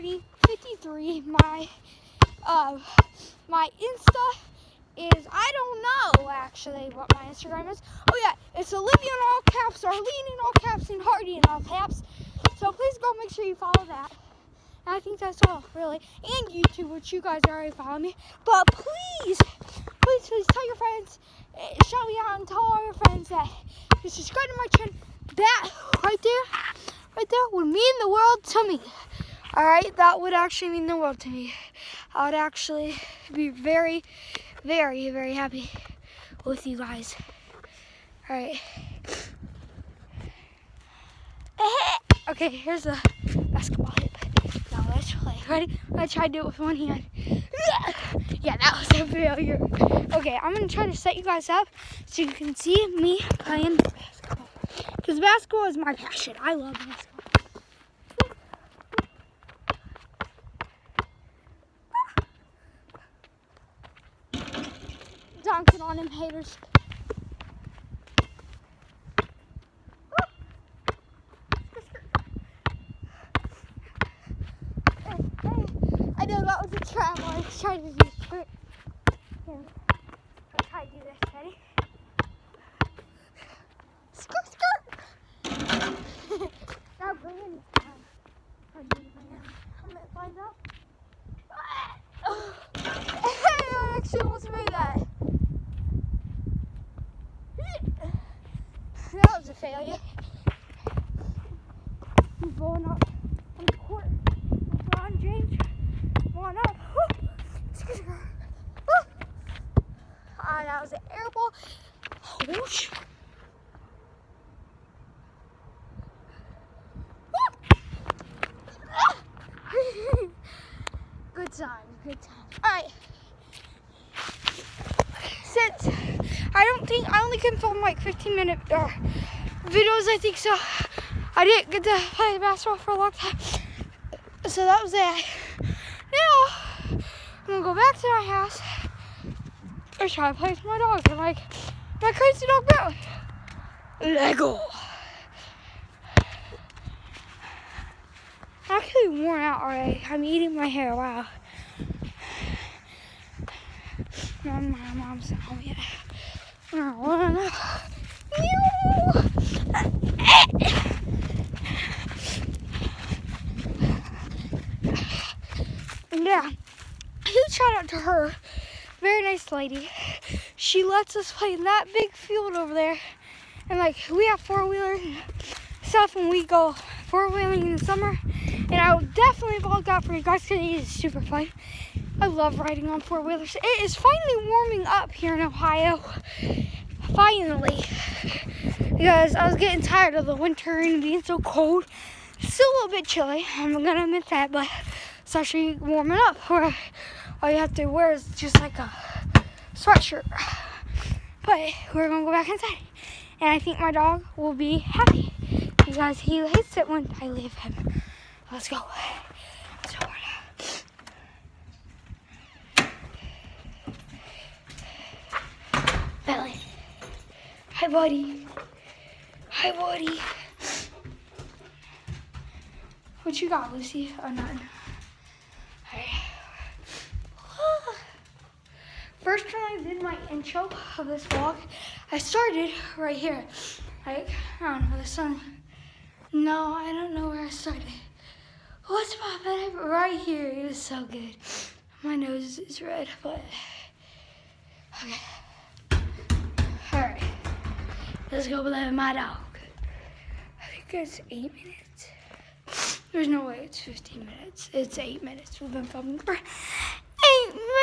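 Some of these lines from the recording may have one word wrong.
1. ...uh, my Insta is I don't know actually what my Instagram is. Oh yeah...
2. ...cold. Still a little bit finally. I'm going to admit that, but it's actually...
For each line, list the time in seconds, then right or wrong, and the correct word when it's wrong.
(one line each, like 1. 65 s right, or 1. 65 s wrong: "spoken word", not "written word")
1. 2 s right
2. 191 s wrong: "chilly", not "finally".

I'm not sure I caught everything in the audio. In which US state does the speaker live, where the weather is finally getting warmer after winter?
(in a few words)
Ohio.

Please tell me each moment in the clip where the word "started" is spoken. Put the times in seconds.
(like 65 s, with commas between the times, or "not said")
232 s, 237 s.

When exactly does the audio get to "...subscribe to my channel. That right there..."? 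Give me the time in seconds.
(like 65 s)
24 s.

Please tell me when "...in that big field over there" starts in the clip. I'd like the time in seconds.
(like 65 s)
171 s.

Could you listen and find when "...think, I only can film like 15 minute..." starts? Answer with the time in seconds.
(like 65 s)
126 s.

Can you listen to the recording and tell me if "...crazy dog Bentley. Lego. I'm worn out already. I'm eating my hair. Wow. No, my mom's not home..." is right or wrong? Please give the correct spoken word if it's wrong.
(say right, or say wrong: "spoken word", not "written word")
right.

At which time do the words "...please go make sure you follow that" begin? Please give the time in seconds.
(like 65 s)
12 s.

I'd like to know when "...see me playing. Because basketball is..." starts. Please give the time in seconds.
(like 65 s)
52 s.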